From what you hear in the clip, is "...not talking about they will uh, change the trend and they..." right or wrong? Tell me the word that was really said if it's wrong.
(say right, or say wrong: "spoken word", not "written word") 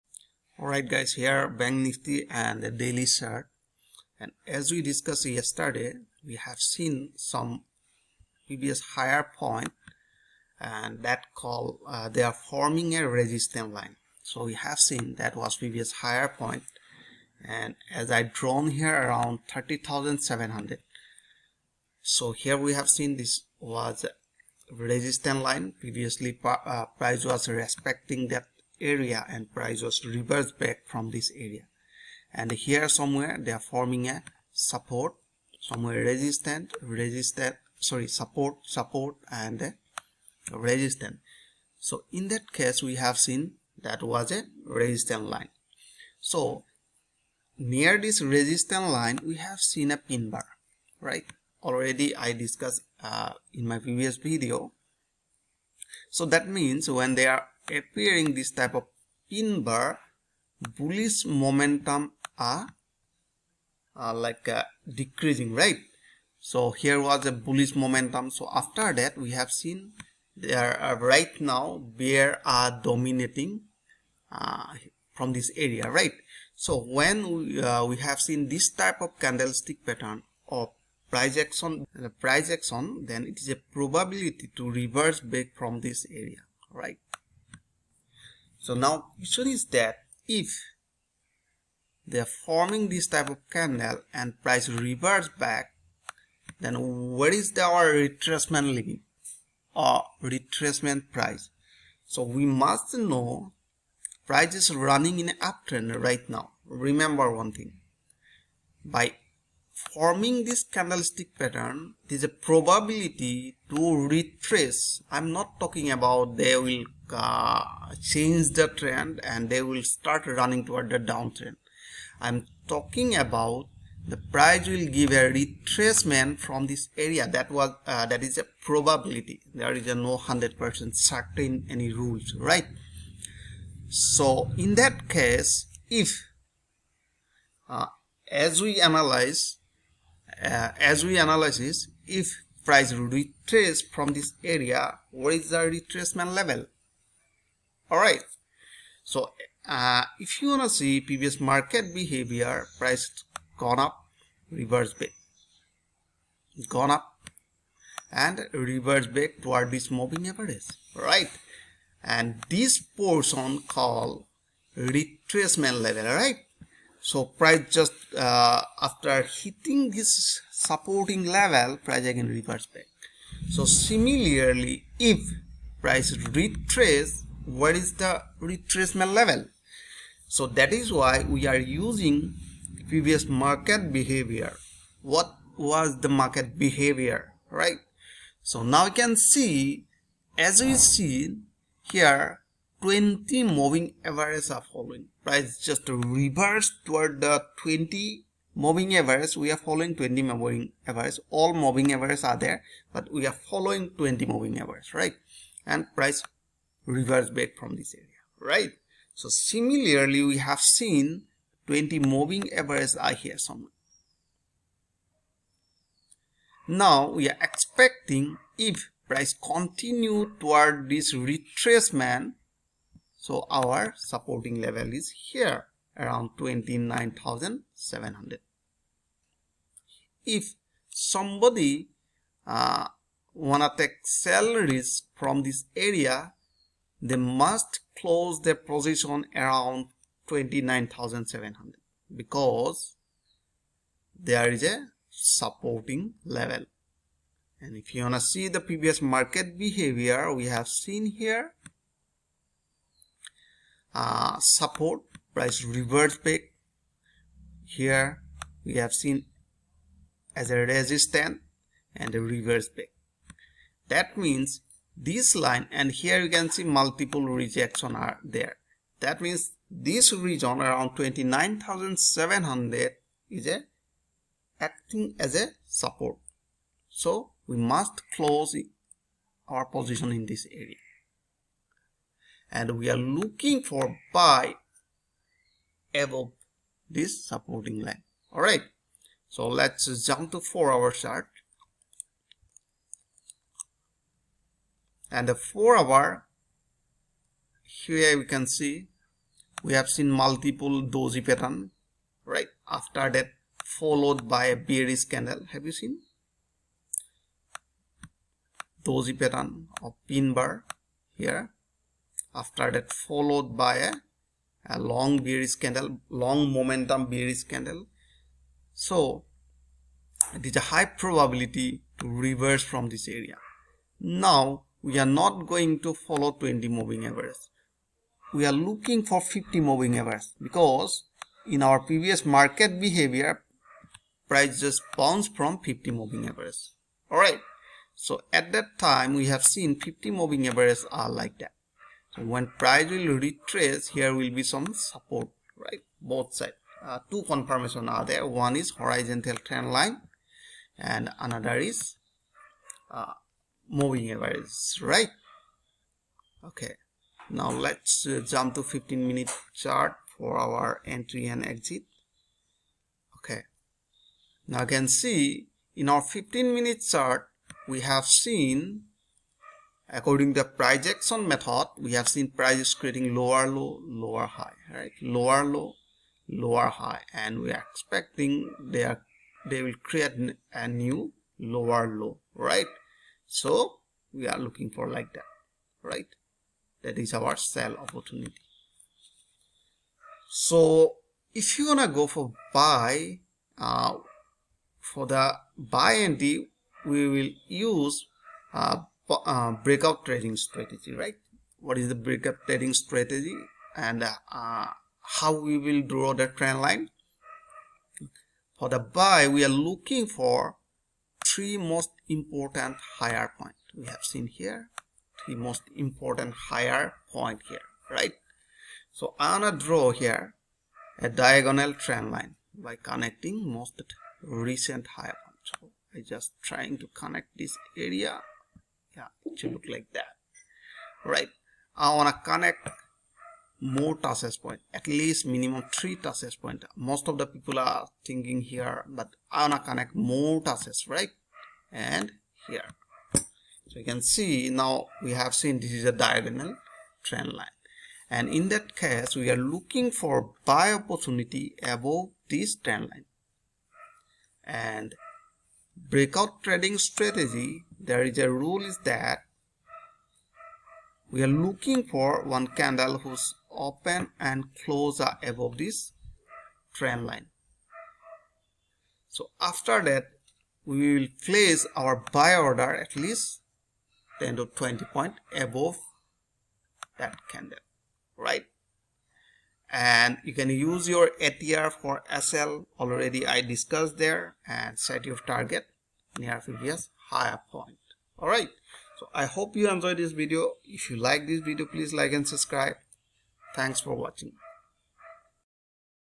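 right.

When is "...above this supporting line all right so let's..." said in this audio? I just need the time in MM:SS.
04:45.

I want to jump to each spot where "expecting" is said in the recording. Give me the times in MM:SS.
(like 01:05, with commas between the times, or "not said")
03:37, 06:17.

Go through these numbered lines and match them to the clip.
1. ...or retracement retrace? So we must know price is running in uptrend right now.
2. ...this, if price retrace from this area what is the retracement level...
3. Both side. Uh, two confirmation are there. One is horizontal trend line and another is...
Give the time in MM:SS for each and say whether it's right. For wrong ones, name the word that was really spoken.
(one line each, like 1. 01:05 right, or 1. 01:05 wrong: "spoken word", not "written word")
1. 01:39 wrong: "price", not "retrace"
2. 02:21 right
3. 05:46 right.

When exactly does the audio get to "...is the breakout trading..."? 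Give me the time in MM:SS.
06:41.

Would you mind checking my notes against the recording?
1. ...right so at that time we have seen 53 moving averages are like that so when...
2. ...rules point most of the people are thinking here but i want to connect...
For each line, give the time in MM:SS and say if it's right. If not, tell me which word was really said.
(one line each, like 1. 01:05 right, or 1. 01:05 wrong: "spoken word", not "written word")
1. 05:37 wrong: "50", not "53"
2. 07:15 wrong: "touches", not "rules".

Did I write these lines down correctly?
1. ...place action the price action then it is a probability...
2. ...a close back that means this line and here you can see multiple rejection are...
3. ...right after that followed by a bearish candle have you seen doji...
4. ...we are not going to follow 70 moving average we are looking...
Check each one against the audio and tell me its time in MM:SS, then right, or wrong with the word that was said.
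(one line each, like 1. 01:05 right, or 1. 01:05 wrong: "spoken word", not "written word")
1. 01:21 wrong: "price", not "place"
2. 04:22 wrong: "reverse", not "close"
3. 05:02 right
4. 05:24 wrong: "20", not "70".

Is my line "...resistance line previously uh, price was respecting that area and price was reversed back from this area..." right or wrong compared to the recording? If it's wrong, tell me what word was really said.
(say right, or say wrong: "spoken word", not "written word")
right.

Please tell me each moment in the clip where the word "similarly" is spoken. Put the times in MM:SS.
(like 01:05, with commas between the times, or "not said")
02:53, 03:29.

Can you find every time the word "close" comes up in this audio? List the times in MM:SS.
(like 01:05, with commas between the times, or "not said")
03:57, 04:38, 07:44.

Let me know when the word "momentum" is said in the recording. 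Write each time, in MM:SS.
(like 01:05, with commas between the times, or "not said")
01:01, 01:07, 05:16.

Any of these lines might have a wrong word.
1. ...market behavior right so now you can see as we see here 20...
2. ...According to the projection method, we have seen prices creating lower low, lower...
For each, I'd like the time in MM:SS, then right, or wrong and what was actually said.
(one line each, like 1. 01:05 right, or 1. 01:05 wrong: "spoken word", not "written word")
1. 03:06 right
2. 06:09 right.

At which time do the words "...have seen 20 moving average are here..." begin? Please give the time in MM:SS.
03:30.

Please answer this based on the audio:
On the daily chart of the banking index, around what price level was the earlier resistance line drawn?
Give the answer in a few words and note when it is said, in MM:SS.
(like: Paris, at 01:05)
30,700, at 00:19.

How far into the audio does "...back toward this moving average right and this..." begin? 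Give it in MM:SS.
02:39.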